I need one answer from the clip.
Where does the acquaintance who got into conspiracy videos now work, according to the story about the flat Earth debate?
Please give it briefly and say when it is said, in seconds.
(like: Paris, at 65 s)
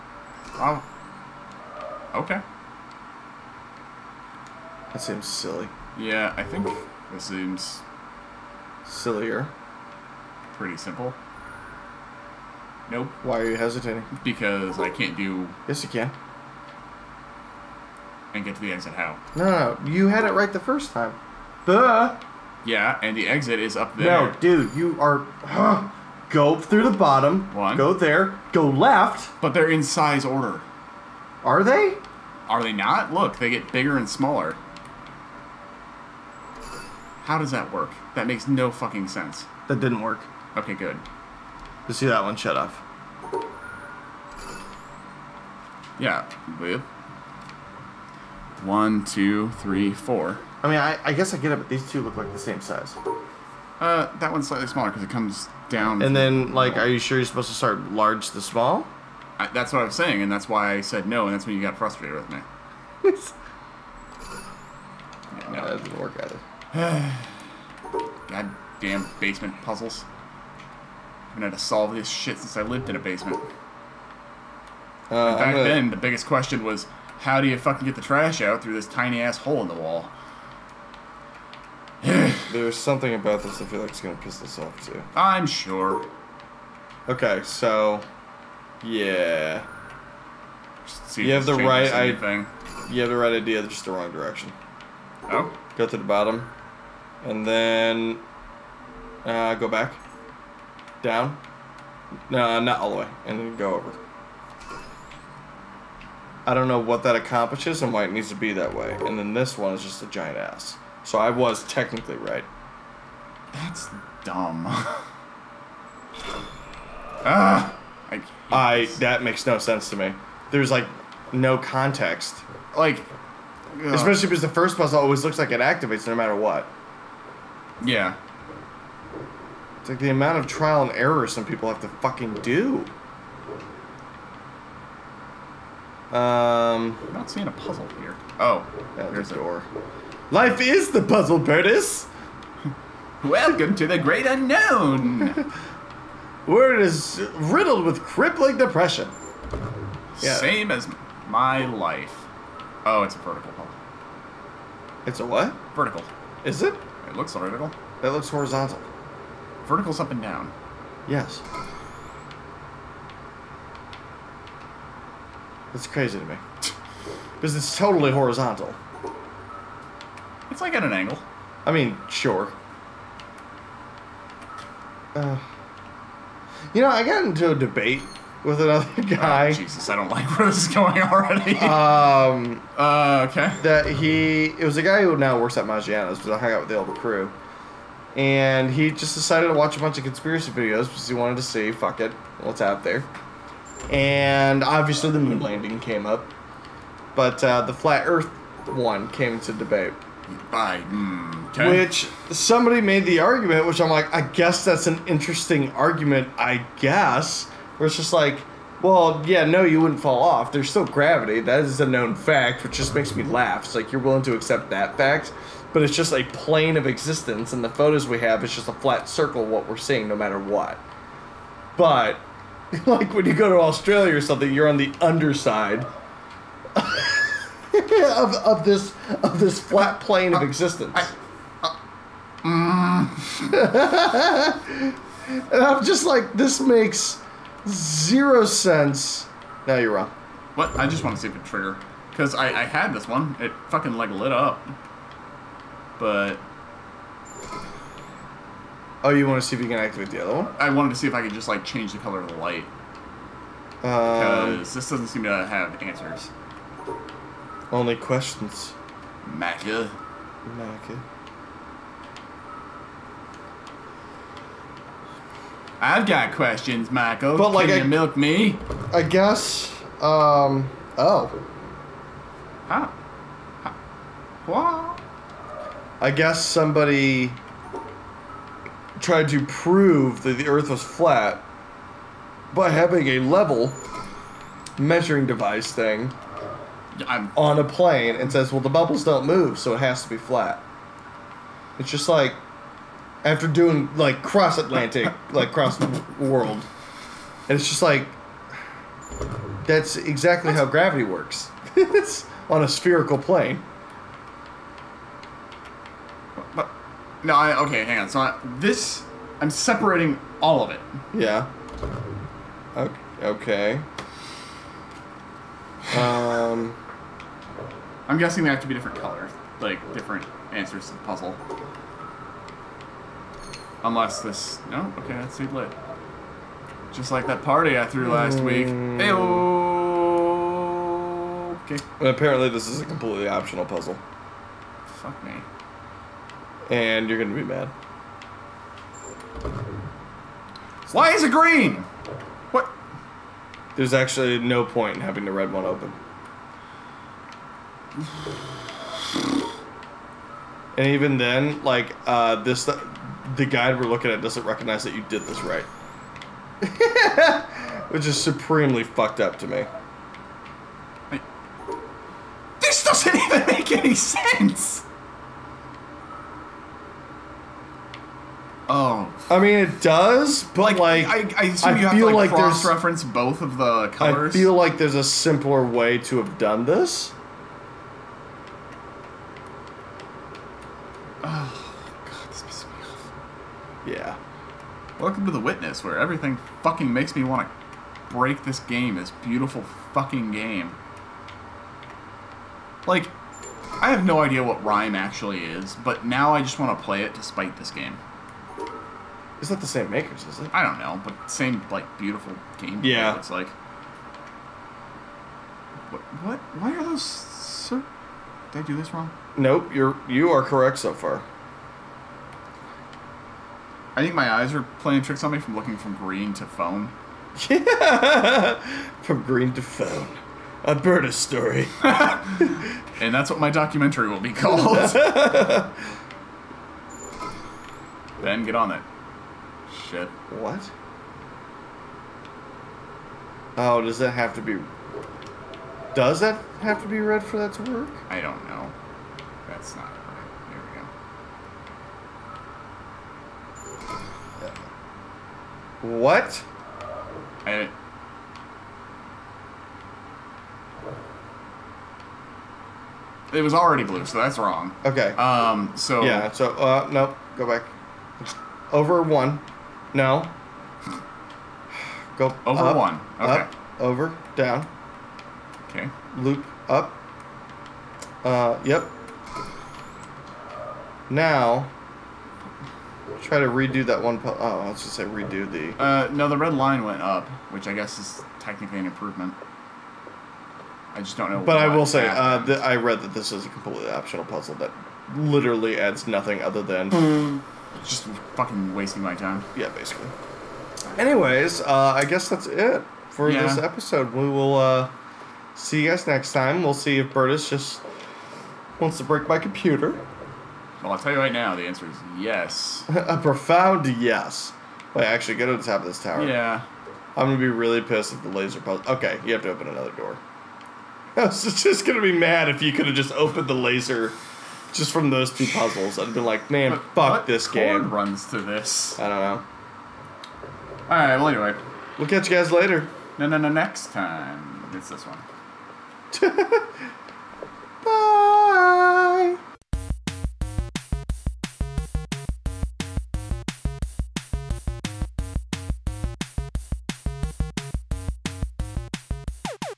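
Maggiano's, at 185 s.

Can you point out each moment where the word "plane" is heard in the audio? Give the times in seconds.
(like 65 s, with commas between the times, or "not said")
216 s, 230 s, 287 s, 303 s.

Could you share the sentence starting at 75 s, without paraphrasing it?
then, the biggest question was, how do you fucking get the trash out through this tiny ass hole in the wall?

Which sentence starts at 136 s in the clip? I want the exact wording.
Um, I'm not seeing a puzzle here.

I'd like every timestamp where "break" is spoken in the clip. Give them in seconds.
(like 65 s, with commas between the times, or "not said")
388 s, 499 s.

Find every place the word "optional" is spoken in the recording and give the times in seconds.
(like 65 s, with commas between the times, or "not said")
333 s, 483 s.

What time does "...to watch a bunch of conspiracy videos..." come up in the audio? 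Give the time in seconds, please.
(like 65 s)
189 s.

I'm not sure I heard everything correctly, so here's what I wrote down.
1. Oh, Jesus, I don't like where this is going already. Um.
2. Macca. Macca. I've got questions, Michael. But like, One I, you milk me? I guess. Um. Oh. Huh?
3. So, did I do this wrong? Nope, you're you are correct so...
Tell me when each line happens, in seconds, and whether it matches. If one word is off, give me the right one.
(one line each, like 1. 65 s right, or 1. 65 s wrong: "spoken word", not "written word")
1. 179 s right
2. 259 s wrong: "Can", not "One"
3. 407 s right.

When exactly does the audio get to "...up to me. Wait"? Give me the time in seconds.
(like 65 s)
359 s.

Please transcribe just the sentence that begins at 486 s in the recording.
Hmm just fucking wasting my time.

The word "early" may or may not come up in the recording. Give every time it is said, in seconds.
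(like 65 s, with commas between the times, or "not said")
not said.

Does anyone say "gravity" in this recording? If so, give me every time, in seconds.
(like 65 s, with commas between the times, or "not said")
210 s, 300 s.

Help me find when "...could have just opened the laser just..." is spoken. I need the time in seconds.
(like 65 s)
512 s.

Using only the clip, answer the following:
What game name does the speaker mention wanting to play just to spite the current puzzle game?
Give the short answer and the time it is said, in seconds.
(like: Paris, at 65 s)
Rime, at 394 s.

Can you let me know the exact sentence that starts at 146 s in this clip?
Word is riddled with crippling depression.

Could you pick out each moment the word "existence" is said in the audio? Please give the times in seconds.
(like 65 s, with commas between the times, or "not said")
216 s, 230 s.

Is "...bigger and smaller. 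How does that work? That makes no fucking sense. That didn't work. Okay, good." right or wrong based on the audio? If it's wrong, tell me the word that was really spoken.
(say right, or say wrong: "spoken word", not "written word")
right.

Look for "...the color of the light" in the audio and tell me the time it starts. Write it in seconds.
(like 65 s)
251 s.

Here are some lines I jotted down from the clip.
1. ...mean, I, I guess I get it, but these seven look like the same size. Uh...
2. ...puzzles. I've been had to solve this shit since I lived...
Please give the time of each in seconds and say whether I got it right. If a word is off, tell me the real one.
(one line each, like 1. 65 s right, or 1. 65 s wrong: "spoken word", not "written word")
1. 50 s wrong: "two", not "seven"
2. 69 s right.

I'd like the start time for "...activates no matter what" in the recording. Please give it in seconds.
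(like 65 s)
125 s.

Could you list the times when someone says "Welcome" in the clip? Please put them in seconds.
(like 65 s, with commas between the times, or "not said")
143 s, 385 s.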